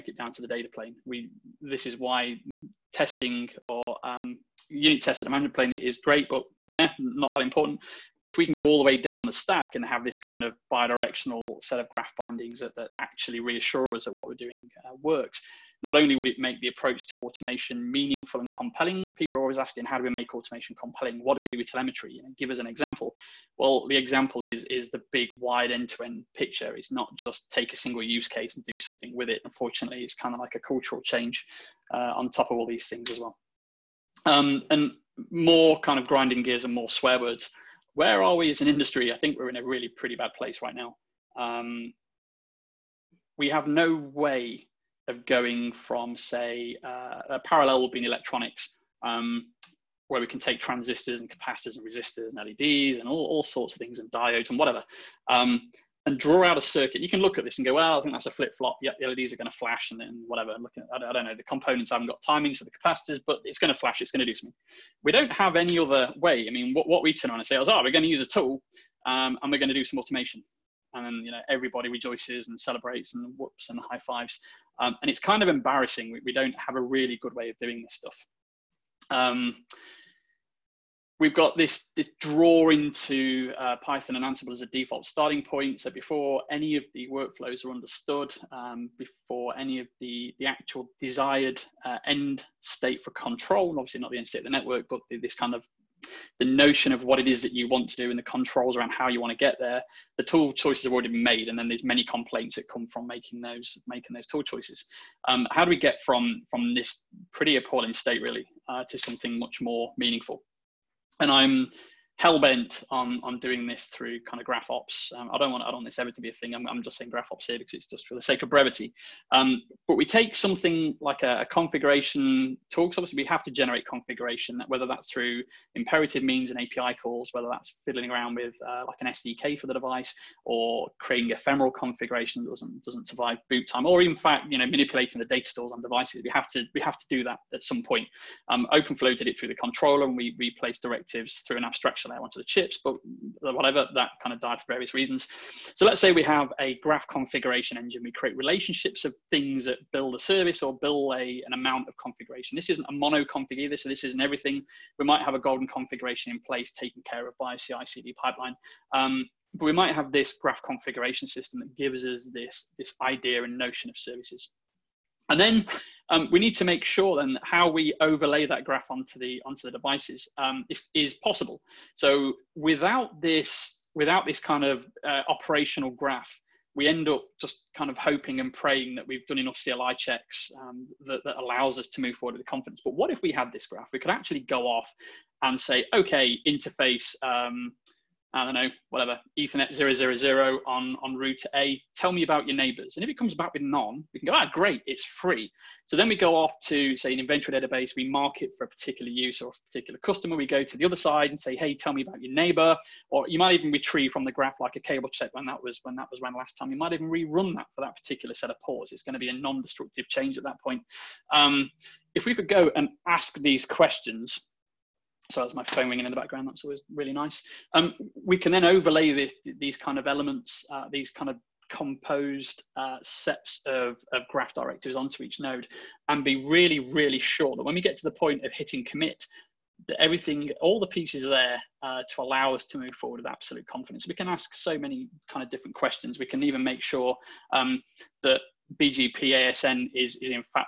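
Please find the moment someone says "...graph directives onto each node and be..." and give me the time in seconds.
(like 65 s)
224 s.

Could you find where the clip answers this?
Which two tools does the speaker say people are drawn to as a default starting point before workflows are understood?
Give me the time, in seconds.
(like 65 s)
83 s.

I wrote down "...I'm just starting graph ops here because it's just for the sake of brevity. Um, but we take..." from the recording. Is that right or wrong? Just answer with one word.
wrong.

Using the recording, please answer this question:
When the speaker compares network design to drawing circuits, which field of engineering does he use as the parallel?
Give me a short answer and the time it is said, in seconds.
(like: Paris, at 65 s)
Electronics, at 48 s.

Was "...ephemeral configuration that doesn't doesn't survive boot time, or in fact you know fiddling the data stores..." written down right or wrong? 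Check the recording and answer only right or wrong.
wrong.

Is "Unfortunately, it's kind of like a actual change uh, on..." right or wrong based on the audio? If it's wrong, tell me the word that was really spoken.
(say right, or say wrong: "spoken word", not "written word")
wrong: "cultural", not "actual".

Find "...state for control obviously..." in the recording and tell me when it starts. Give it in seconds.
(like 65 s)
92 s.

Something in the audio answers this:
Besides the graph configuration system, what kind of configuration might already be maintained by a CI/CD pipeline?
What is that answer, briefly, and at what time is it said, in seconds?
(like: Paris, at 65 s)
Golden configuration, at 155 s.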